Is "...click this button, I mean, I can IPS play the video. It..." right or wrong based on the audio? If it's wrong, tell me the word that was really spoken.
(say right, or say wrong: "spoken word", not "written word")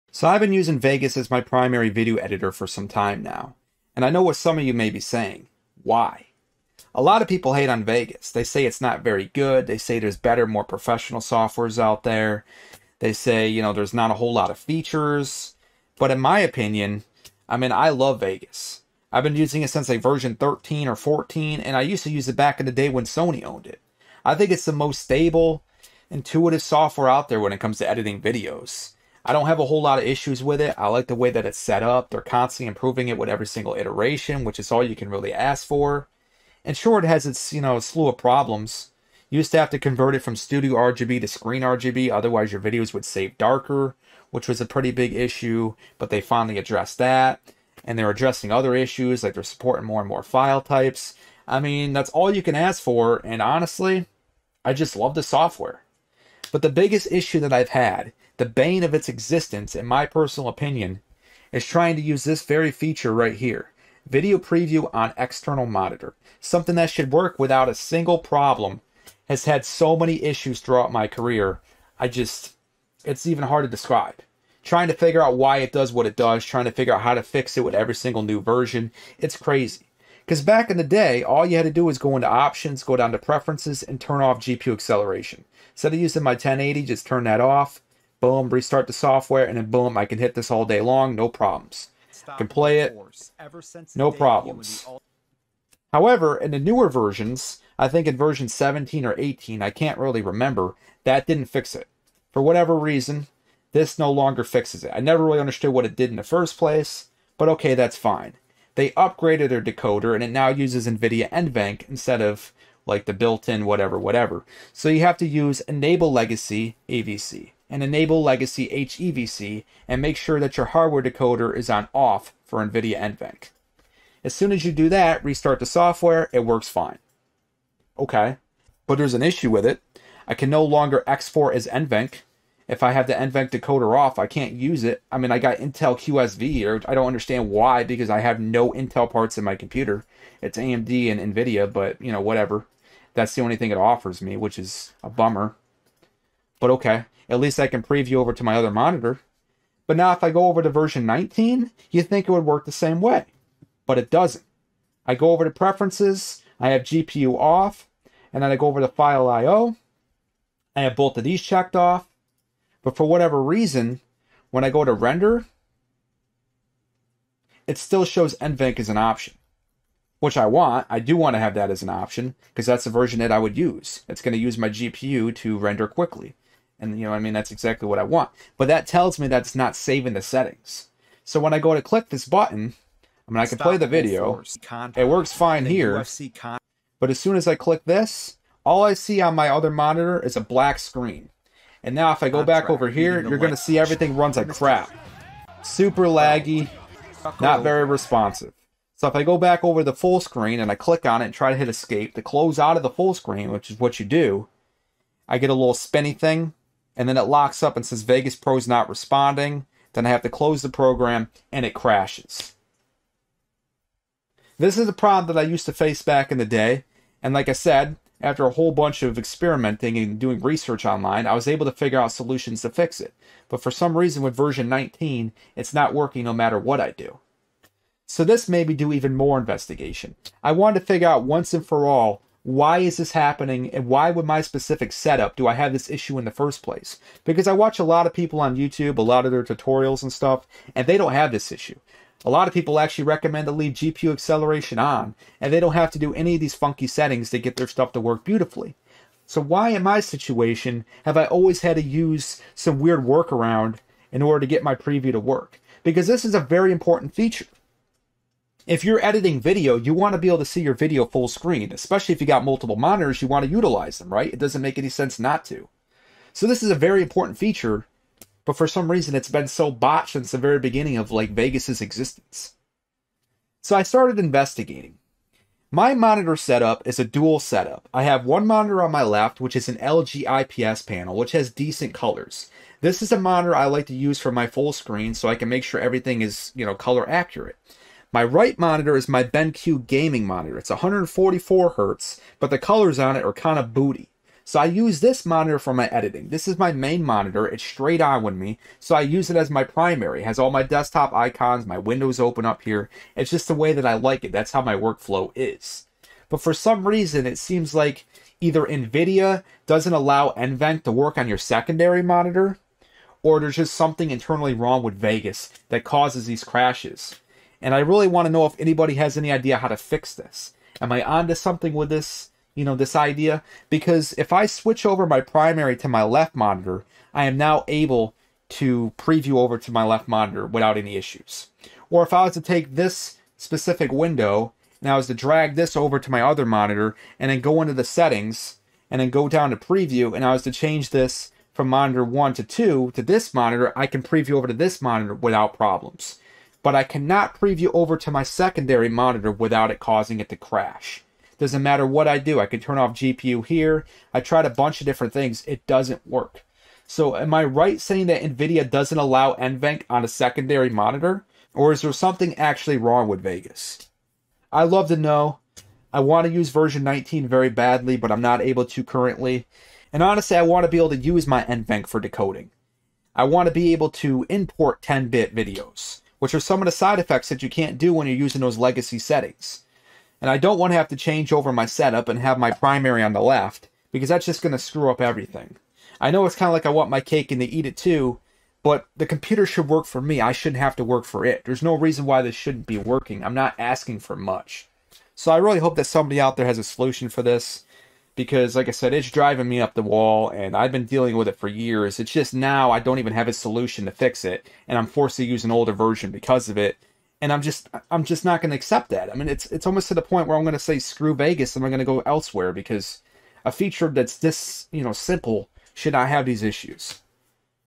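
wrong: "Stop", not "IPS".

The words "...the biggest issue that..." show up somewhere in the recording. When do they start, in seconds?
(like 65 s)
56 s.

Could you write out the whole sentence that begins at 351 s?
Doesn't matter what I do, I can turn off GPU here.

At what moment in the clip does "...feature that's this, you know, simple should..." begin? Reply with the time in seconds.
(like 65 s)
413 s.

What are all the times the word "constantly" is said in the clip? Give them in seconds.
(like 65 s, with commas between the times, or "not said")
32 s.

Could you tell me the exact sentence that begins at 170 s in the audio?
I do want to have that as an option because that's the version that I would use.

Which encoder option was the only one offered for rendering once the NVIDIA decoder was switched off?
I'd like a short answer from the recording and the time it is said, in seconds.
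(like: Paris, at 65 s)
Intel QSV, at 135 s.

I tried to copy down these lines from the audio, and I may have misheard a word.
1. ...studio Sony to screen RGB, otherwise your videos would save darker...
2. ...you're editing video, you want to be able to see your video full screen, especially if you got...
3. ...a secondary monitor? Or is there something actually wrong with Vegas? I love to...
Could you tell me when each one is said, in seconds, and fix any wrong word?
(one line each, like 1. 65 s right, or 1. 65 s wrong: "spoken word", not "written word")
1. 40 s wrong: "RGB", not "Sony"
2. 258 s right
3. 360 s right.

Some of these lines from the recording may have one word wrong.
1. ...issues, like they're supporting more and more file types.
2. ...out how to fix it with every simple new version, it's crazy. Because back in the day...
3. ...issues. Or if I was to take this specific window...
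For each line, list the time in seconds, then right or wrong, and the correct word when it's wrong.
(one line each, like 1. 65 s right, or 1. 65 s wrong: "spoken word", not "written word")
1. 48 s right
2. 76 s wrong: "single", not "simple"
3. 330 s right.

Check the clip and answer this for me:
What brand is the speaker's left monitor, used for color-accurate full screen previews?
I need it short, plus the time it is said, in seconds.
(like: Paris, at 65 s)
LG, at 279 s.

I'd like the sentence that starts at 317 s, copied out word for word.
And I really want to know if anybody has any idea how to fix this.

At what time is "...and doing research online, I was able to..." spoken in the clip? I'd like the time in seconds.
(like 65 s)
219 s.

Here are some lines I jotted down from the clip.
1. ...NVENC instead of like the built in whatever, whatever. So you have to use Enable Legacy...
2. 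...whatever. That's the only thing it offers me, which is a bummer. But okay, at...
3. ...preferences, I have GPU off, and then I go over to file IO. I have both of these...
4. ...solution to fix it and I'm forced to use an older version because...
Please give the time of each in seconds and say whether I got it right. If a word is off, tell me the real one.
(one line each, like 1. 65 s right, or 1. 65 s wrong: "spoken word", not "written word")
1. 111 s right
2. 142 s right
3. 155 s right
4. 403 s right.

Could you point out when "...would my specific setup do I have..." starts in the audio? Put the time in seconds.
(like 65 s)
234 s.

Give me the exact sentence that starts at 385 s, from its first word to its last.
I know it's kind of like I want my cake and to eat it too, but the computer should work for me.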